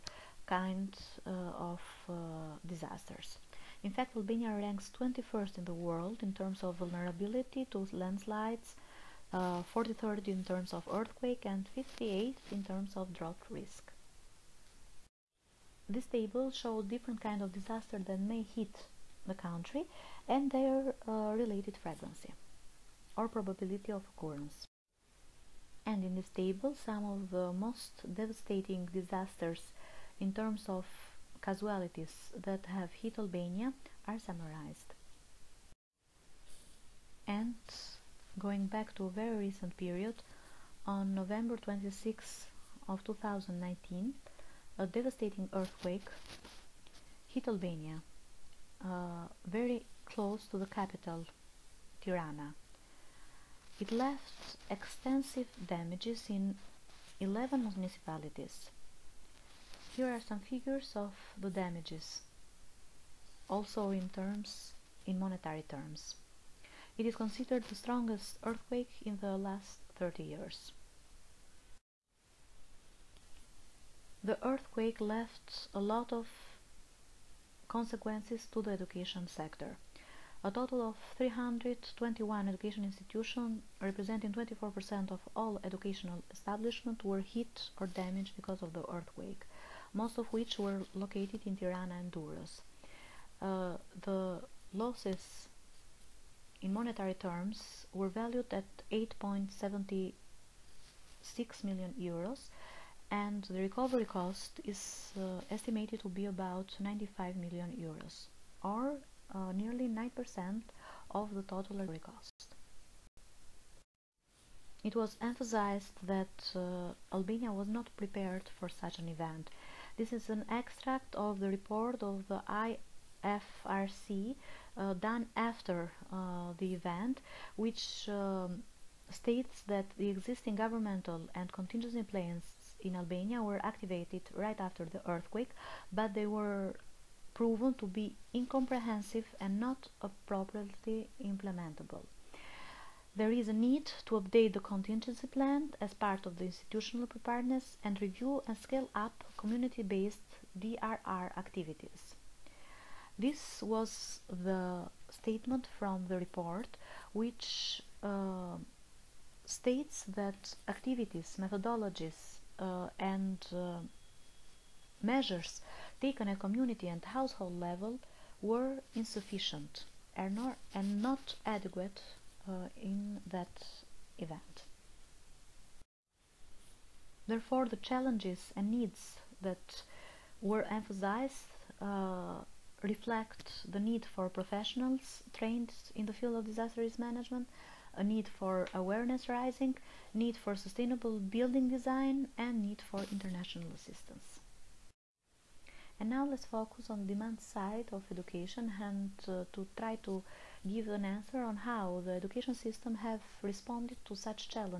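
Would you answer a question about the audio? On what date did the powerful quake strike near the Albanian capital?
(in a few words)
November 26, 2019.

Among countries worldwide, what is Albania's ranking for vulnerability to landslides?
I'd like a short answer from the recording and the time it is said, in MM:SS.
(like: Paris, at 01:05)
21st, at 00:04.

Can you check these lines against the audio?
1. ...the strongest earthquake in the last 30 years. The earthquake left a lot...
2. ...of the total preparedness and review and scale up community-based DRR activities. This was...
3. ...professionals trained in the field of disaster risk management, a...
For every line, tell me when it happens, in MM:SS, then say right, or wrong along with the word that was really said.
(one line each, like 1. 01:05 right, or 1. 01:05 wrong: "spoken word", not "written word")
1. 01:07 right
2. 02:26 wrong: "institutional", not "total"
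3. 03:04 right.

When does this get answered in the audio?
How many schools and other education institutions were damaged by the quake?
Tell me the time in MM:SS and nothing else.
01:21.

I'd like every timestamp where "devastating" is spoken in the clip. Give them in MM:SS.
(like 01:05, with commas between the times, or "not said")
00:28, 00:44.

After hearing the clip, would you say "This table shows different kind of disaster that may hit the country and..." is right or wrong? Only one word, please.
right.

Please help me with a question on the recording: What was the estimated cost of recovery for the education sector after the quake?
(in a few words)
95 million euros.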